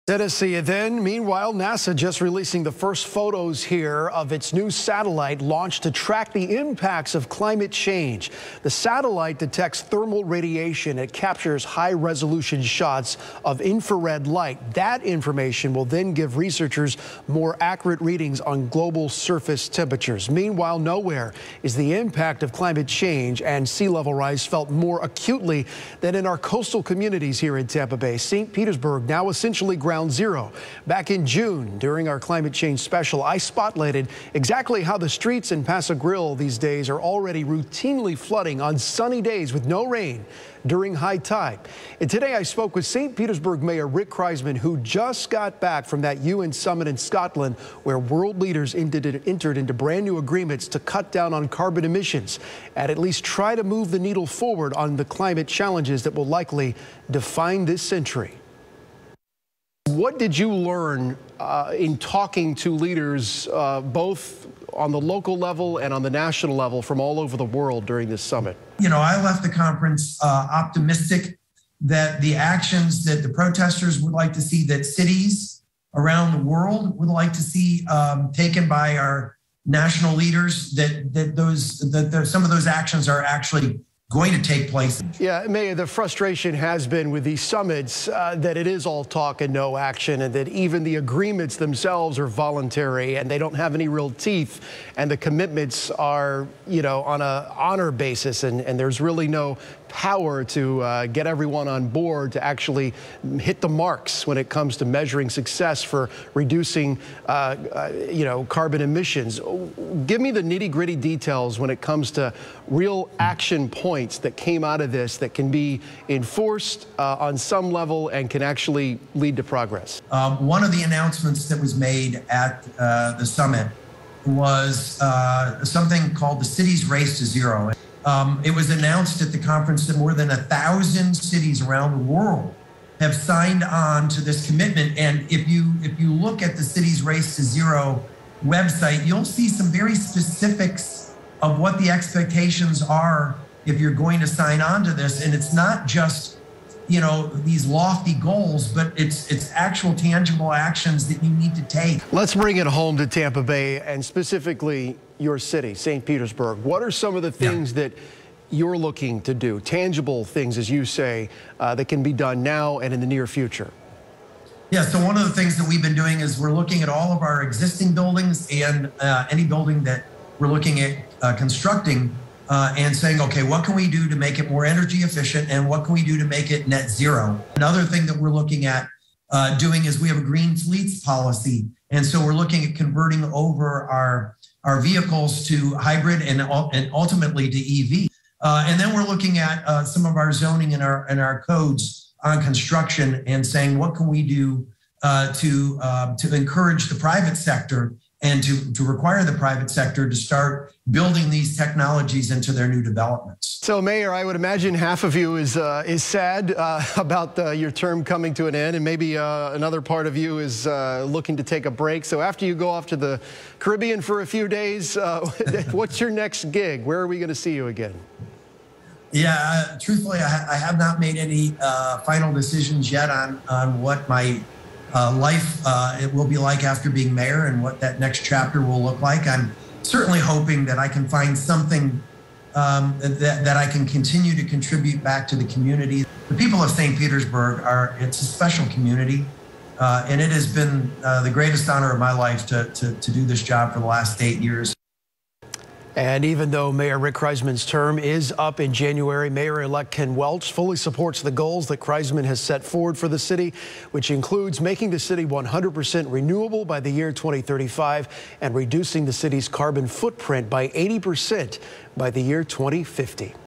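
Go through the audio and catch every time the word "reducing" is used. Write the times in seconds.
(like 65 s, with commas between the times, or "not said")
106 s, 258 s.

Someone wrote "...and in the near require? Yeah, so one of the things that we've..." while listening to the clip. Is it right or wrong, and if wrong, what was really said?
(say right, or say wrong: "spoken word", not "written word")
wrong: "future", not "require".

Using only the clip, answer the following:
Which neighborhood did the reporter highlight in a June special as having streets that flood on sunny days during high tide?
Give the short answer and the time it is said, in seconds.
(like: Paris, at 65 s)
Pass-a-Grille, at 35 s.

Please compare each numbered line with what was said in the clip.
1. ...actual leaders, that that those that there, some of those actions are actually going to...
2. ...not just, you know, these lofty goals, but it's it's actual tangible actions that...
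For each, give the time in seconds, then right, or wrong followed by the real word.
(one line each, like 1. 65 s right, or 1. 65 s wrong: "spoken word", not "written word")
1. 79 s wrong: "national", not "actual"
2. 145 s right.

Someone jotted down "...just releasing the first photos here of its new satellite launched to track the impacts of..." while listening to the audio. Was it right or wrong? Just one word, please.
right.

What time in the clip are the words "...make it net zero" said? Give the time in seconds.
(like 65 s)
176 s.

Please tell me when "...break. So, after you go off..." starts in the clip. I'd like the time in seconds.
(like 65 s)
211 s.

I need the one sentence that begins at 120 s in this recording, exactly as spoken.
Um, one of the announcements that was made at uh, the summit was uh, something called the Cities Race to Zero.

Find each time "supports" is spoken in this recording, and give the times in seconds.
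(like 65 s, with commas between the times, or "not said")
250 s.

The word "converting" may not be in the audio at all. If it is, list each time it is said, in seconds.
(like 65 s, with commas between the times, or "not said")
182 s.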